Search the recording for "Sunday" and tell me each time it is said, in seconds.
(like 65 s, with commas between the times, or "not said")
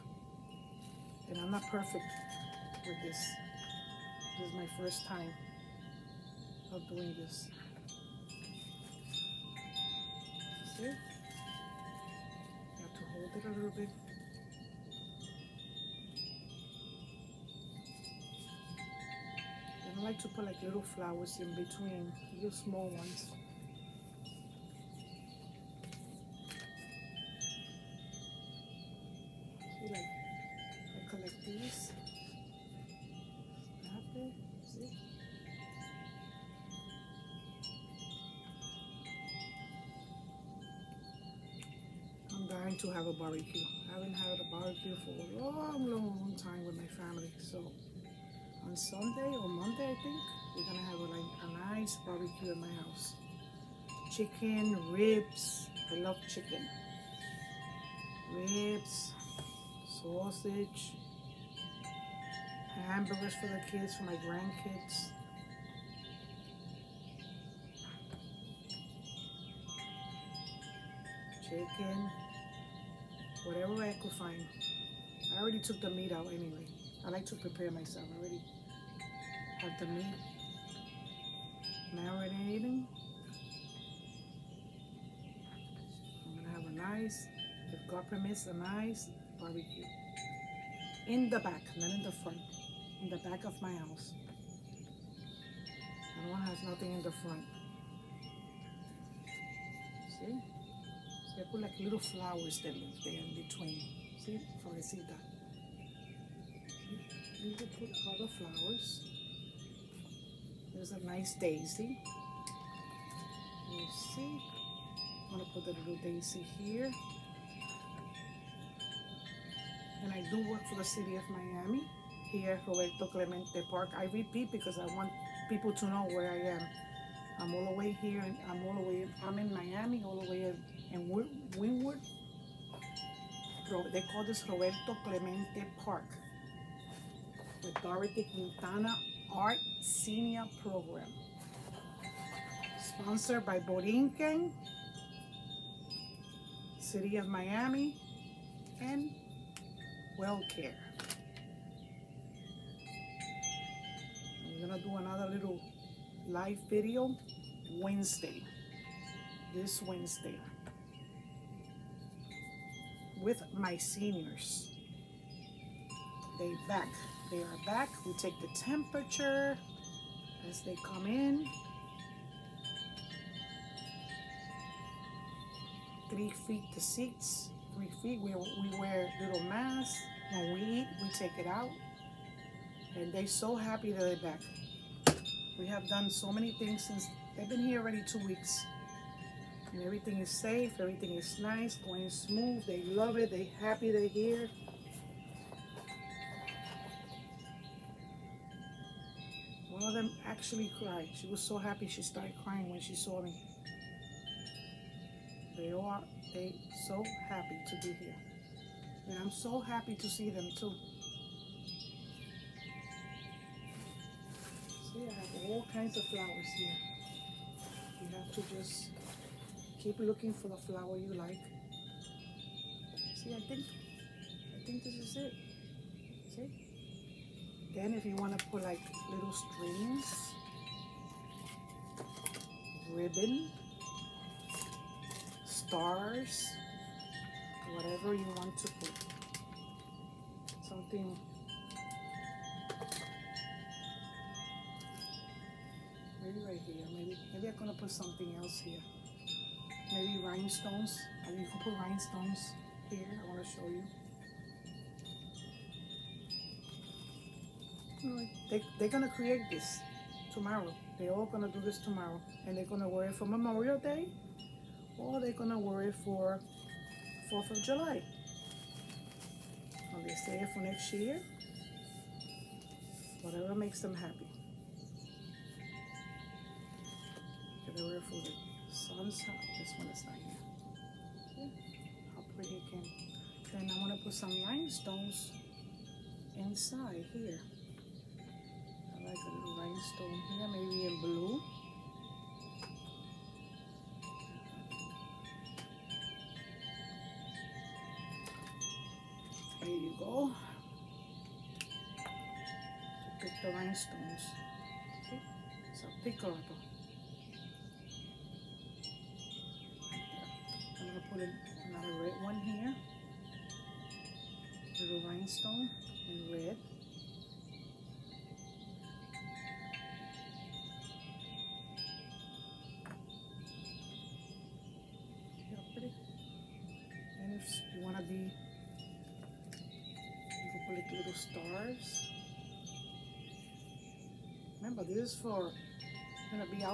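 48 s.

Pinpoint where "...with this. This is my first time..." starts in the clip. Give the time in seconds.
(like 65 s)
2 s.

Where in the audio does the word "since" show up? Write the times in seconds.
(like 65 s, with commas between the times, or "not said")
186 s.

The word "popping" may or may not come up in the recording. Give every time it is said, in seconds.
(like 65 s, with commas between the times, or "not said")
not said.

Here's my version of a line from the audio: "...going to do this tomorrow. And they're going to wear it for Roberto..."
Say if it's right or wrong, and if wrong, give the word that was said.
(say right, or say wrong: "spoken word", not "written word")
wrong: "Memorial", not "Roberto".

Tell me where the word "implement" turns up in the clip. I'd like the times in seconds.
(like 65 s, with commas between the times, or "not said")
not said.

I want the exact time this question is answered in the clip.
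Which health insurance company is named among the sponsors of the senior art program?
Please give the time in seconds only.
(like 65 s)
150 s.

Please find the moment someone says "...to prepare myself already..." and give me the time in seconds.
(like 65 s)
77 s.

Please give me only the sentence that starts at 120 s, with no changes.
And I do work for the city of Miami here, Roberto Clemente Park.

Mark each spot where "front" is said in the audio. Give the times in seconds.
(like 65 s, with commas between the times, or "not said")
92 s, 97 s.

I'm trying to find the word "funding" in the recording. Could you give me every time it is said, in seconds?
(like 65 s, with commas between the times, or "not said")
not said.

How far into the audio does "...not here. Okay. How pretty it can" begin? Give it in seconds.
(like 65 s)
280 s.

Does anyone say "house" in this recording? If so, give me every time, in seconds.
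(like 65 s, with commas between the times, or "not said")
52 s, 93 s.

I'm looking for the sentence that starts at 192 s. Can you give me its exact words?
They love it, they're happy they're here.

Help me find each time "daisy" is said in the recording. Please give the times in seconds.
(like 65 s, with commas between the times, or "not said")
111 s, 116 s.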